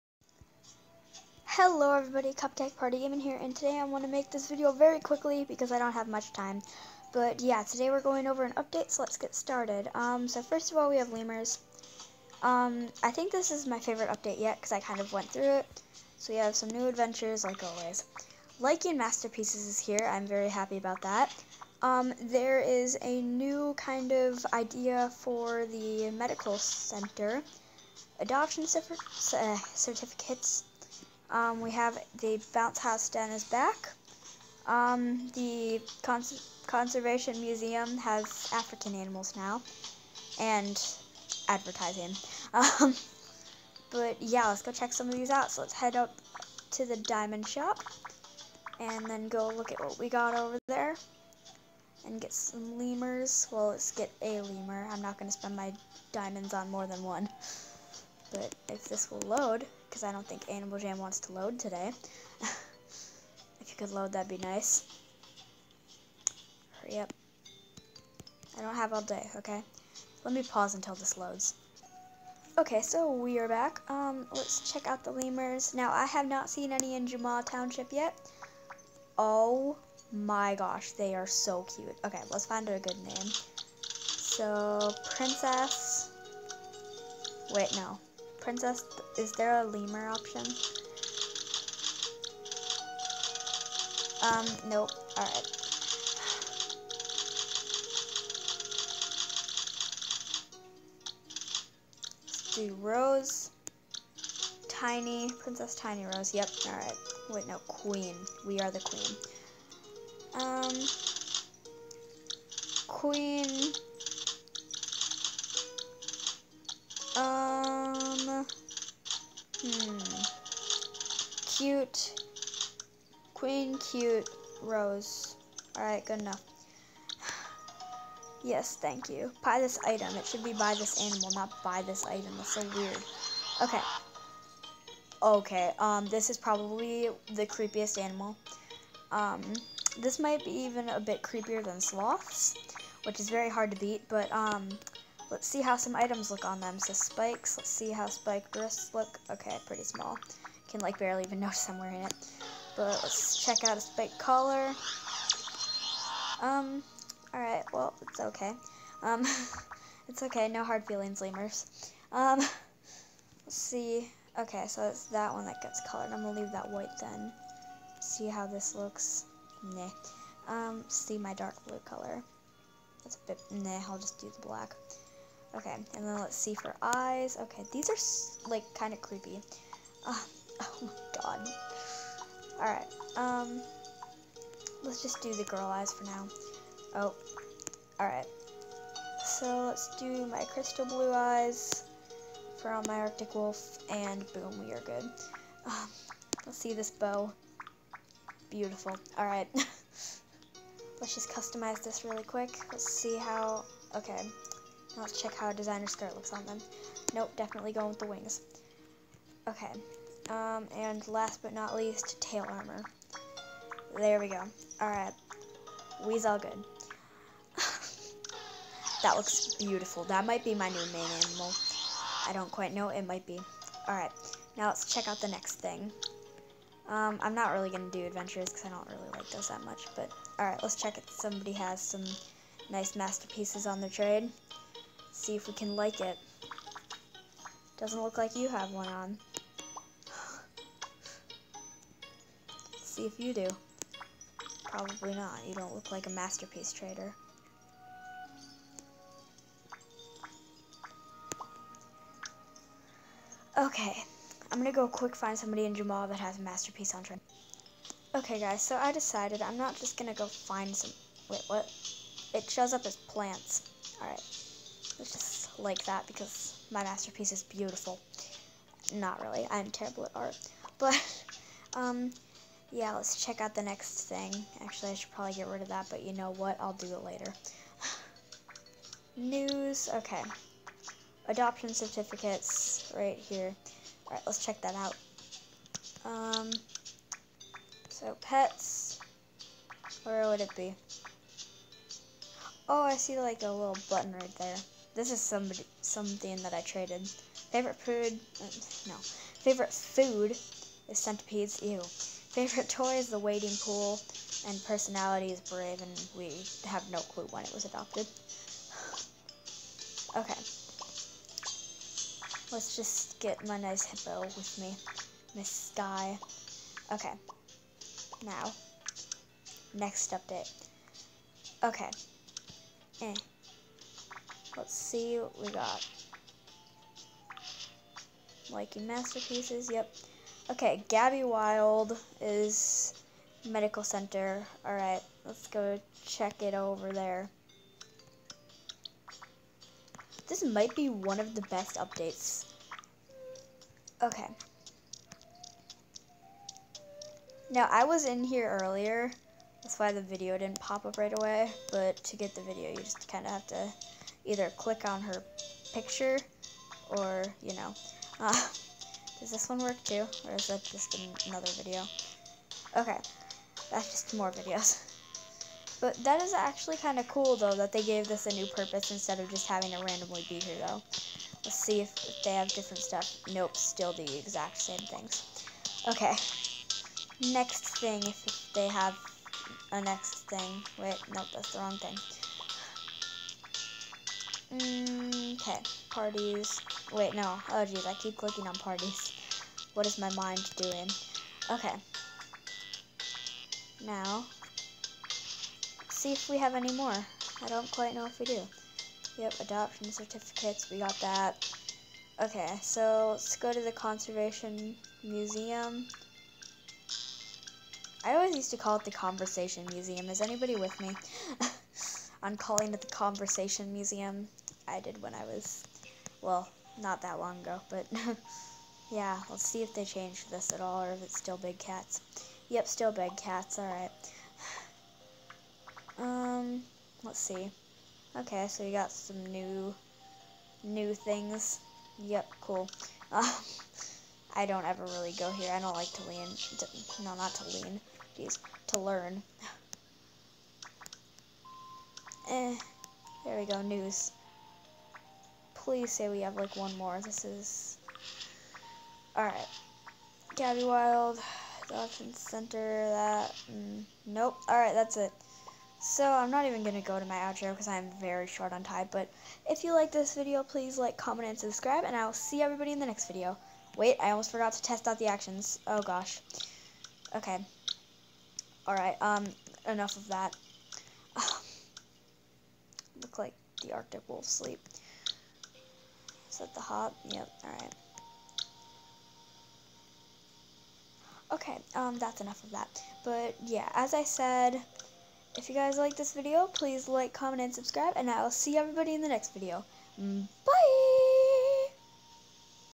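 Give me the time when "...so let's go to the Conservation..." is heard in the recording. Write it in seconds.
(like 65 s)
402 s.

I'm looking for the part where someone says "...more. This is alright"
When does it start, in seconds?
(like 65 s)
446 s.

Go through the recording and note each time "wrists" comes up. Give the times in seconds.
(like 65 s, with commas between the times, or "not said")
148 s.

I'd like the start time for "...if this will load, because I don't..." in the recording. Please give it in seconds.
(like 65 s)
58 s.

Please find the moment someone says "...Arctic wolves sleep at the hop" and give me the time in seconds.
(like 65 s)
473 s.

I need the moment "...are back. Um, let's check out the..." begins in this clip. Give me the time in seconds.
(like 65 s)
73 s.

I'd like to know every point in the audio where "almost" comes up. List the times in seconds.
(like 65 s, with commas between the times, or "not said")
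464 s.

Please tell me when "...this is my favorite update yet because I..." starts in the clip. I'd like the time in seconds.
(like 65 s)
13 s.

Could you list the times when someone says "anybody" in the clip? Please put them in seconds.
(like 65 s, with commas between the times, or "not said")
410 s.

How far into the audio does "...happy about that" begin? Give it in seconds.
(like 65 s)
20 s.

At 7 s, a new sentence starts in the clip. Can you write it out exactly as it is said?
But yeah, today we're going over an update, so let's get started.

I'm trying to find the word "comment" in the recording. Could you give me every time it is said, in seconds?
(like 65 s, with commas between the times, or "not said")
460 s, 487 s.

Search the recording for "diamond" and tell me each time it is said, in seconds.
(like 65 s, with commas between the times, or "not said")
46 s, 56 s.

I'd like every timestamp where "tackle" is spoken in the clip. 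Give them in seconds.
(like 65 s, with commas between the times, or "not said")
not said.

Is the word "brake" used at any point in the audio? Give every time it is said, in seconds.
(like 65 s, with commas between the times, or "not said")
not said.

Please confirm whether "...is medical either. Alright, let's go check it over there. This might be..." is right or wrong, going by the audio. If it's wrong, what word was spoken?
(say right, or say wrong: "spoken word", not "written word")
wrong: "center", not "either".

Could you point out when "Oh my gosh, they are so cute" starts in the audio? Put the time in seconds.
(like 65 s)
79 s.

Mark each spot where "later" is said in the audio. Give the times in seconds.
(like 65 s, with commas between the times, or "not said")
277 s.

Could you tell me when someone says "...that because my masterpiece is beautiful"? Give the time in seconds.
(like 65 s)
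265 s.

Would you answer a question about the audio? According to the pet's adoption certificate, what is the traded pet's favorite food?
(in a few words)
Centipedes.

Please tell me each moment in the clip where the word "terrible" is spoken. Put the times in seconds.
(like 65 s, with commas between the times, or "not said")
269 s.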